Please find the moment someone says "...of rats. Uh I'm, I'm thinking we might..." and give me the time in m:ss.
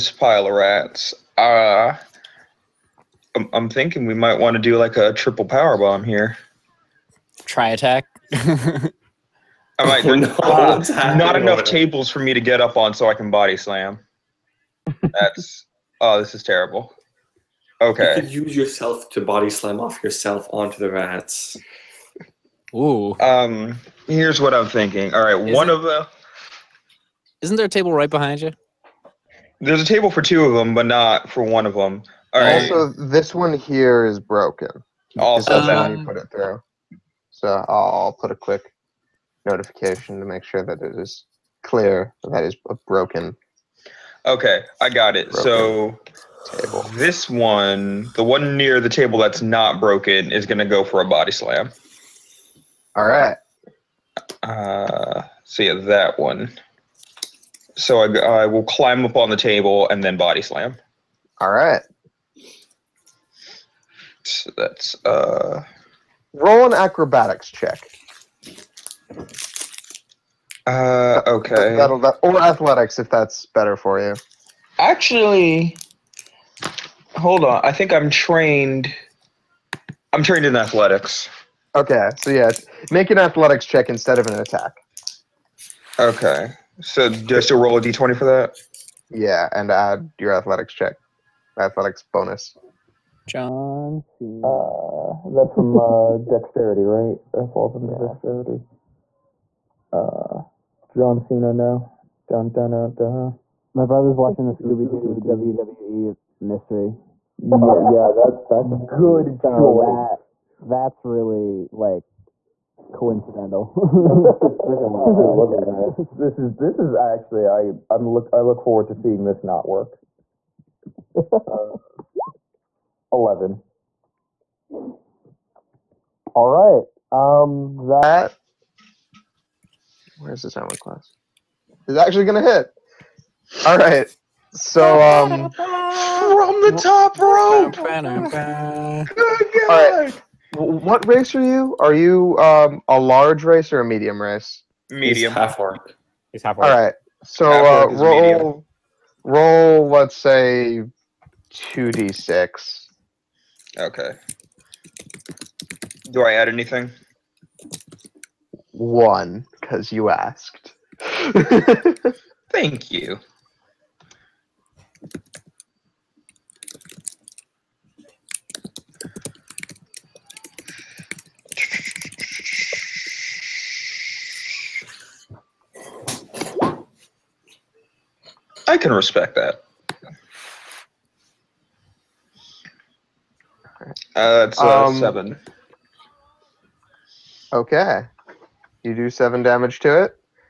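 0:00.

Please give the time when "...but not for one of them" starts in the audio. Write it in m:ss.
0:30.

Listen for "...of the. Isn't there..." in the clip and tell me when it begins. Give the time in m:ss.
0:25.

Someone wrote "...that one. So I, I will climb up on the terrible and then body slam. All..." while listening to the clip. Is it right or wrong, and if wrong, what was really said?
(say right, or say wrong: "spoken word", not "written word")
wrong: "table", not "terrible".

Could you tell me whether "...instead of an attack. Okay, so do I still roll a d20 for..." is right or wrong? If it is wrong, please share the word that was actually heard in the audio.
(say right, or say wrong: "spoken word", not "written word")
right.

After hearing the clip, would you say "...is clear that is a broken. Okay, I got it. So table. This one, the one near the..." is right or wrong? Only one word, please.
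right.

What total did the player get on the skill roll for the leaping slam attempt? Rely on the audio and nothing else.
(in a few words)
11.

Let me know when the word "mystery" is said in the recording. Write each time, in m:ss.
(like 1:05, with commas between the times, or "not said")
1:46.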